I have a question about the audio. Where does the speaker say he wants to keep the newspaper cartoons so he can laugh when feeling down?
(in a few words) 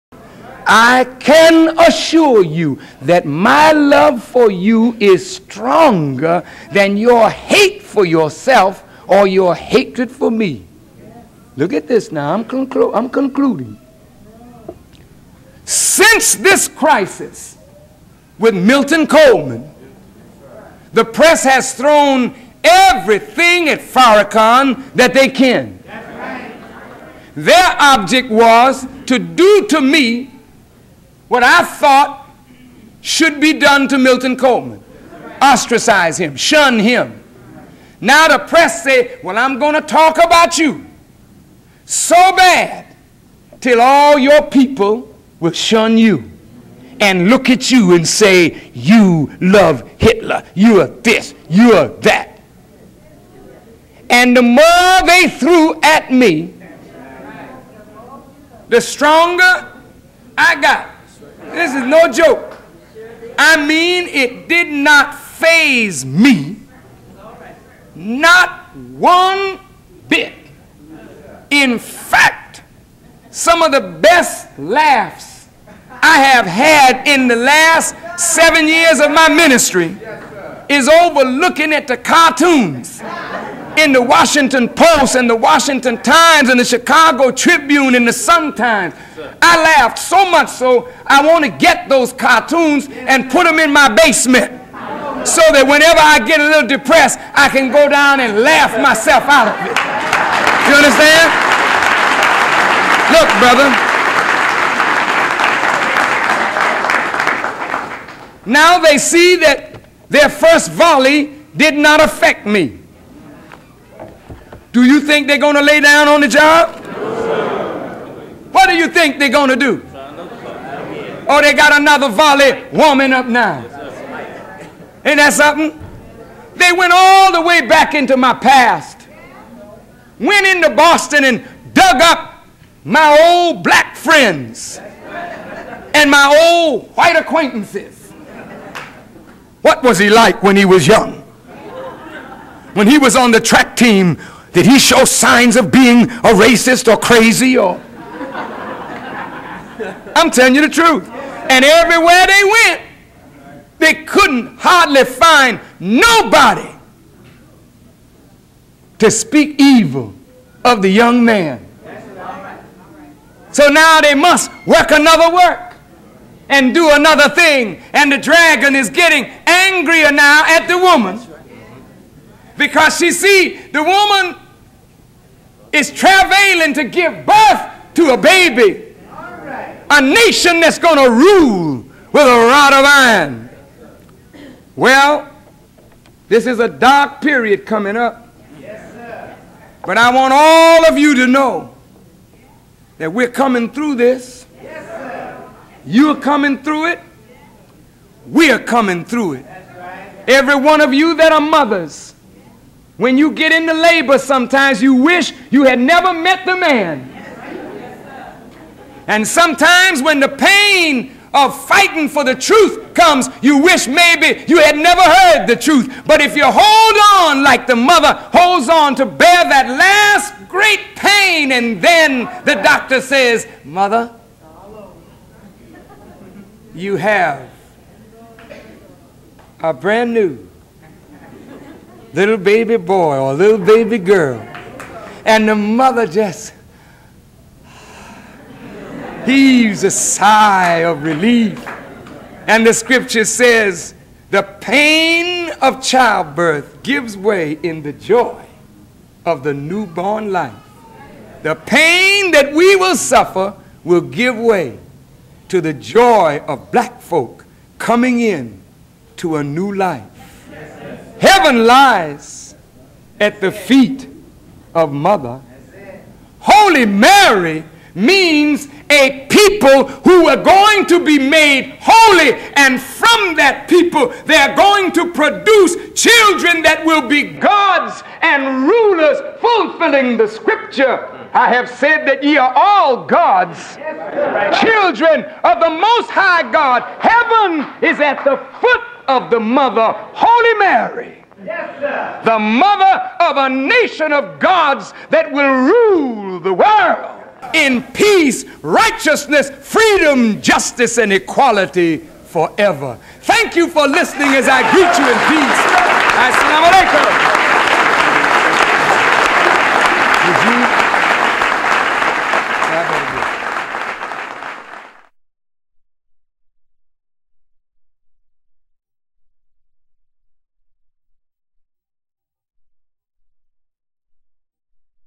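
basement.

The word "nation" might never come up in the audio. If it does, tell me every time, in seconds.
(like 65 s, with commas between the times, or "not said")
180 s, 293 s.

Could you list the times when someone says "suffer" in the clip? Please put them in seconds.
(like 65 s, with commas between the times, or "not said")
252 s.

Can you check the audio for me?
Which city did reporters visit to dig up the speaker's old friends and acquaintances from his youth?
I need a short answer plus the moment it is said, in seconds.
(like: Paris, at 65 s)
Boston, at 130 s.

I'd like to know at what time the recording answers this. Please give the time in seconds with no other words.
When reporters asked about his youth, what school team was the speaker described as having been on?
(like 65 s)
143 s.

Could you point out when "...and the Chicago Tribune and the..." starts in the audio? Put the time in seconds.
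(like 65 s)
86 s.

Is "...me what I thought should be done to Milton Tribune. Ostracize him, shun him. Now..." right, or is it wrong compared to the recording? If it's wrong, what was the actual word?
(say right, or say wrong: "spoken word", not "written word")
wrong: "Coleman", not "Tribune".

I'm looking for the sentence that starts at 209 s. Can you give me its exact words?
And sometimes when the pain of fighting for the truth comes, you wish maybe you had never heard the truth.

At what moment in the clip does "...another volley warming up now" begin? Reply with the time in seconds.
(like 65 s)
121 s.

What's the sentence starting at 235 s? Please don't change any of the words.
And the mother just heaves a sigh of relief.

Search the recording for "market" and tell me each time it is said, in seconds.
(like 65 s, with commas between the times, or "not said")
not said.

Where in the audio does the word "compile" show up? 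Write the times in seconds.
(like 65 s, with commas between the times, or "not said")
not said.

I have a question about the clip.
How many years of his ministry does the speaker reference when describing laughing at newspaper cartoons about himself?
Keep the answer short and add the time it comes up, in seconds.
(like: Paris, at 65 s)
7, at 78 s.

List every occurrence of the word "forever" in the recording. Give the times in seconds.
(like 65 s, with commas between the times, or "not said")
302 s.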